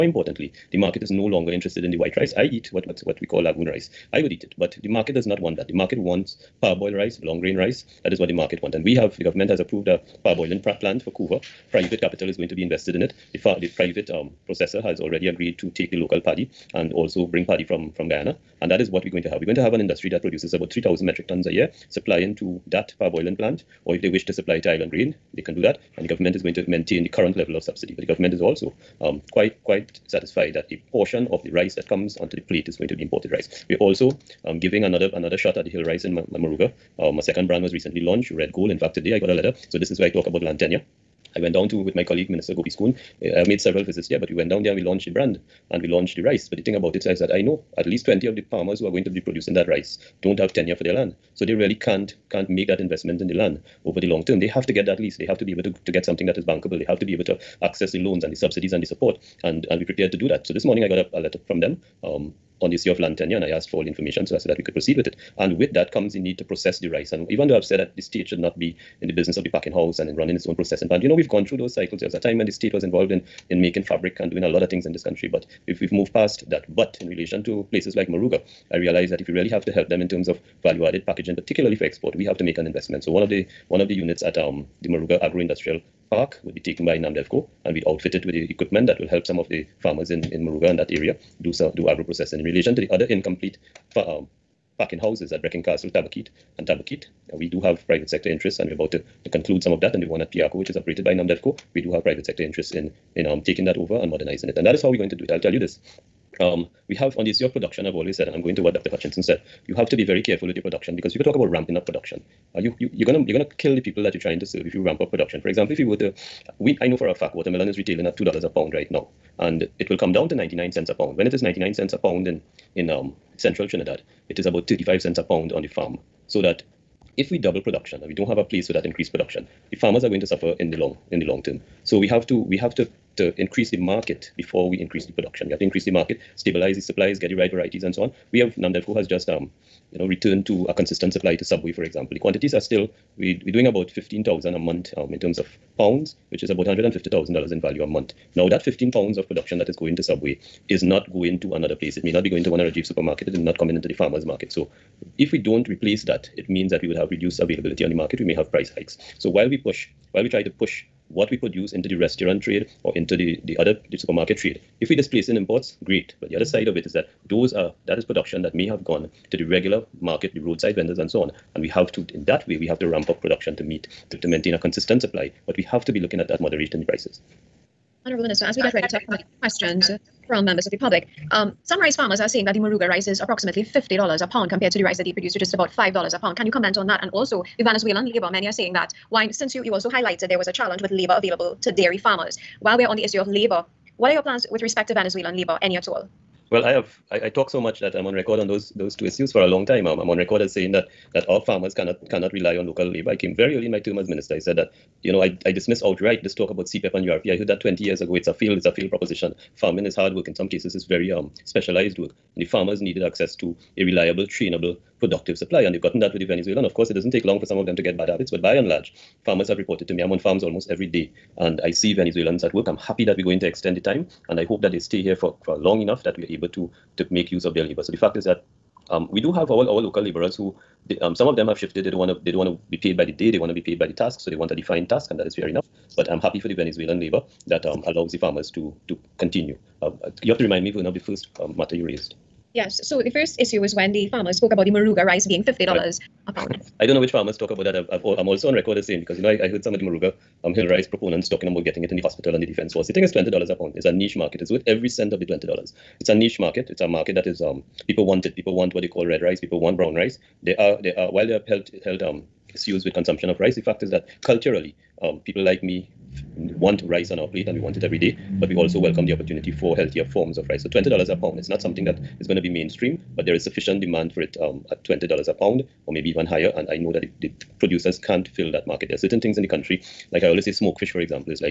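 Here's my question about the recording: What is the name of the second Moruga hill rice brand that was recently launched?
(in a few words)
Red Gold.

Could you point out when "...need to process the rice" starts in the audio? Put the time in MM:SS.
01:06.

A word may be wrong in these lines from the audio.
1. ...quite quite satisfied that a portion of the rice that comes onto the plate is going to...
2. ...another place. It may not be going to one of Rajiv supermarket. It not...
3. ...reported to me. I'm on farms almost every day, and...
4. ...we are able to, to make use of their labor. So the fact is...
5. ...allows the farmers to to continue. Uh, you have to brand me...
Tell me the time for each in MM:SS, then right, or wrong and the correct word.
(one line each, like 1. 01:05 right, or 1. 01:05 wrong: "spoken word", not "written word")
1. 00:29 right
2. 02:31 right
3. 03:39 right
4. 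03:46 right
5. 03:57 wrong: "remind", not "brand".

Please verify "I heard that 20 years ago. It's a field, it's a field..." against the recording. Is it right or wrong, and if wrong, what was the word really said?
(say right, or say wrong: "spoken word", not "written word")
right.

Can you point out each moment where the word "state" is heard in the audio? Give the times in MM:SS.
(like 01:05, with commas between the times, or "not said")
01:08, 01:12.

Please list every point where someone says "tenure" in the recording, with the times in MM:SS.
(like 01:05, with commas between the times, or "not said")
00:40, 00:50, 01:03.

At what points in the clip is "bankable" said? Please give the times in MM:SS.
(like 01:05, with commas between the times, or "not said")
00:56.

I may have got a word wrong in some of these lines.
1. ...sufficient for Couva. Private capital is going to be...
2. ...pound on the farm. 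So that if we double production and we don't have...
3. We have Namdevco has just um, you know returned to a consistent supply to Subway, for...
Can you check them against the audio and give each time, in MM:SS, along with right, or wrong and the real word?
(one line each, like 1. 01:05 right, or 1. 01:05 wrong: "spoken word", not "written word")
1. 00:10 wrong: "plant", not "sufficient"
2. 02:05 right
3. 02:18 right.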